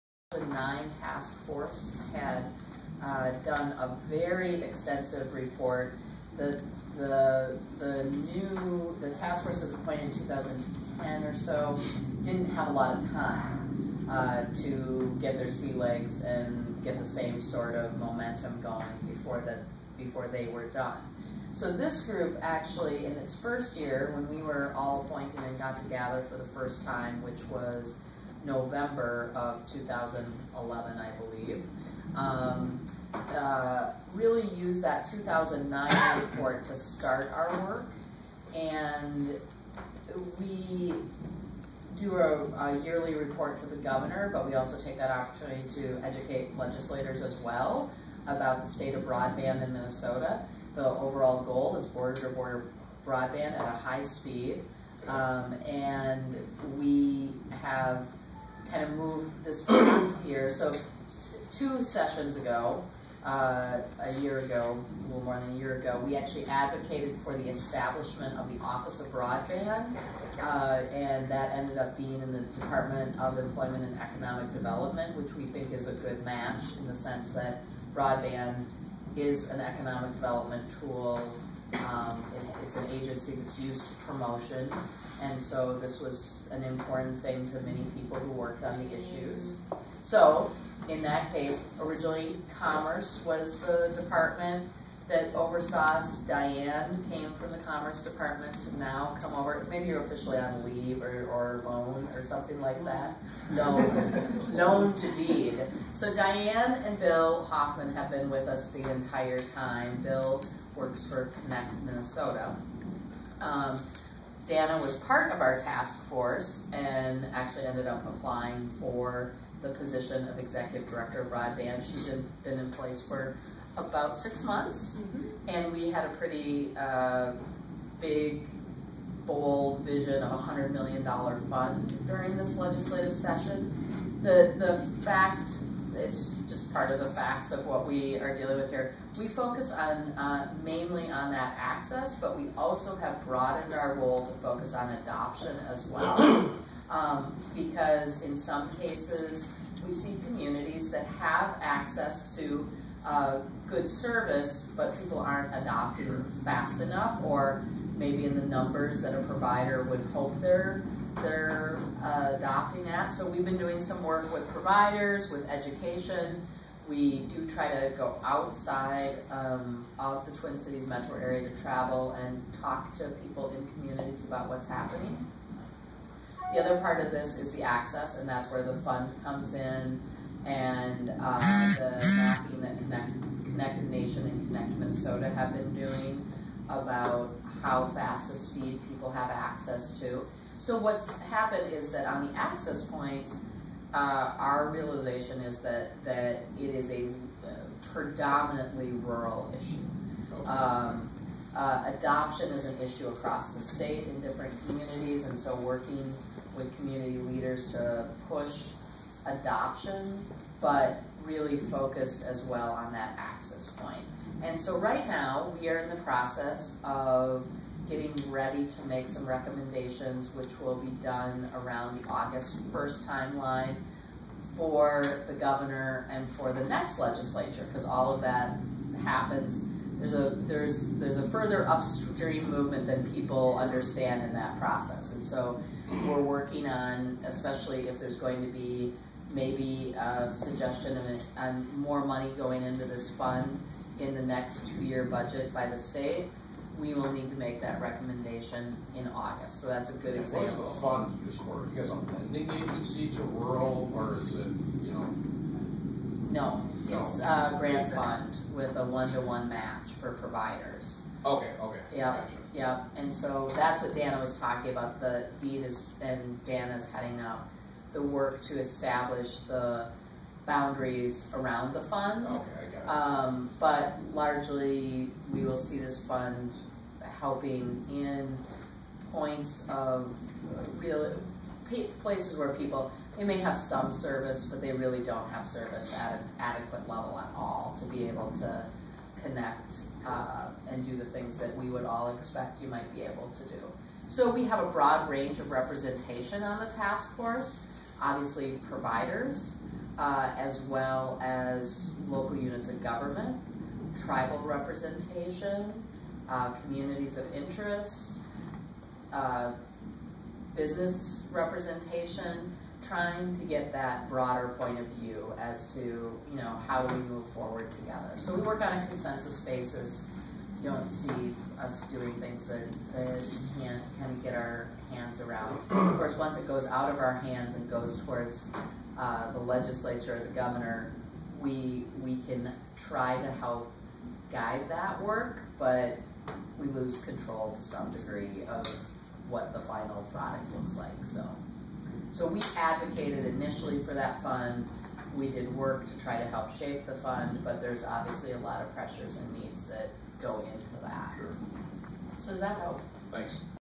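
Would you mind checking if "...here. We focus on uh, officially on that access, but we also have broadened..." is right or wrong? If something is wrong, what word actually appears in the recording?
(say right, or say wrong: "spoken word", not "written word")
wrong: "mainly", not "officially".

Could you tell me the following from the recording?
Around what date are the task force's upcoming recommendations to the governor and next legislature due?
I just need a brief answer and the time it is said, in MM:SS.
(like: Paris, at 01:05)
August 1, at 03:42.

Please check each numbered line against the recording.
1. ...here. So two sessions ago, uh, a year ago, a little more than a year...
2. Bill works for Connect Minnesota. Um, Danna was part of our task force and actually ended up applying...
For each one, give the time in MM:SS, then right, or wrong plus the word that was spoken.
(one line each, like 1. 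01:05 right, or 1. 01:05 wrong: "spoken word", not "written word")
1. 01:00 right
2. 01:50 right.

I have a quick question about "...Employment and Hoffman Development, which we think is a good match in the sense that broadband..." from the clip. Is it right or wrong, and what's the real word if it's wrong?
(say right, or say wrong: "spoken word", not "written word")
wrong: "Economic", not "Hoffman".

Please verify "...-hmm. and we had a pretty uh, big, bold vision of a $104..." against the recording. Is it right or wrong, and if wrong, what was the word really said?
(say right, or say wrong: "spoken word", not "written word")
wrong: "100", not "104".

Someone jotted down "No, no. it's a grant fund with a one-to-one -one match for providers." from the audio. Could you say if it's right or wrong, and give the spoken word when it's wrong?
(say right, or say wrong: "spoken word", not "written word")
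right.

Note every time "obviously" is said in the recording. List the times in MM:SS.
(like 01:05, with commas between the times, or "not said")
04:58, 05:47.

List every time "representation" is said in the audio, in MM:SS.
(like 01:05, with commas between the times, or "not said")
04:55, 05:04, 05:11.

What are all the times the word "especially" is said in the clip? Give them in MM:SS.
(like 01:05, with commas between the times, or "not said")
03:57.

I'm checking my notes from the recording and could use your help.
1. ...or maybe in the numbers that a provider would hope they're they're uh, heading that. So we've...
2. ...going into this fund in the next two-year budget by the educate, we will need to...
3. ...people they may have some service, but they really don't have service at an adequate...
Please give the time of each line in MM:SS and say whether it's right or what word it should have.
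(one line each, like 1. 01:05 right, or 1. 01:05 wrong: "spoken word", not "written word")
1. 02:37 wrong: "adopting", not "heading"
2. 04:02 wrong: "state", not "educate"
3. 04:42 right.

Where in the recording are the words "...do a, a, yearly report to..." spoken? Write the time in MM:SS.
00:41.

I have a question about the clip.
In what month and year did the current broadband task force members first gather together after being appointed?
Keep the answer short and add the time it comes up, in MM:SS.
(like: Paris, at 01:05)
November 2011, at 00:28.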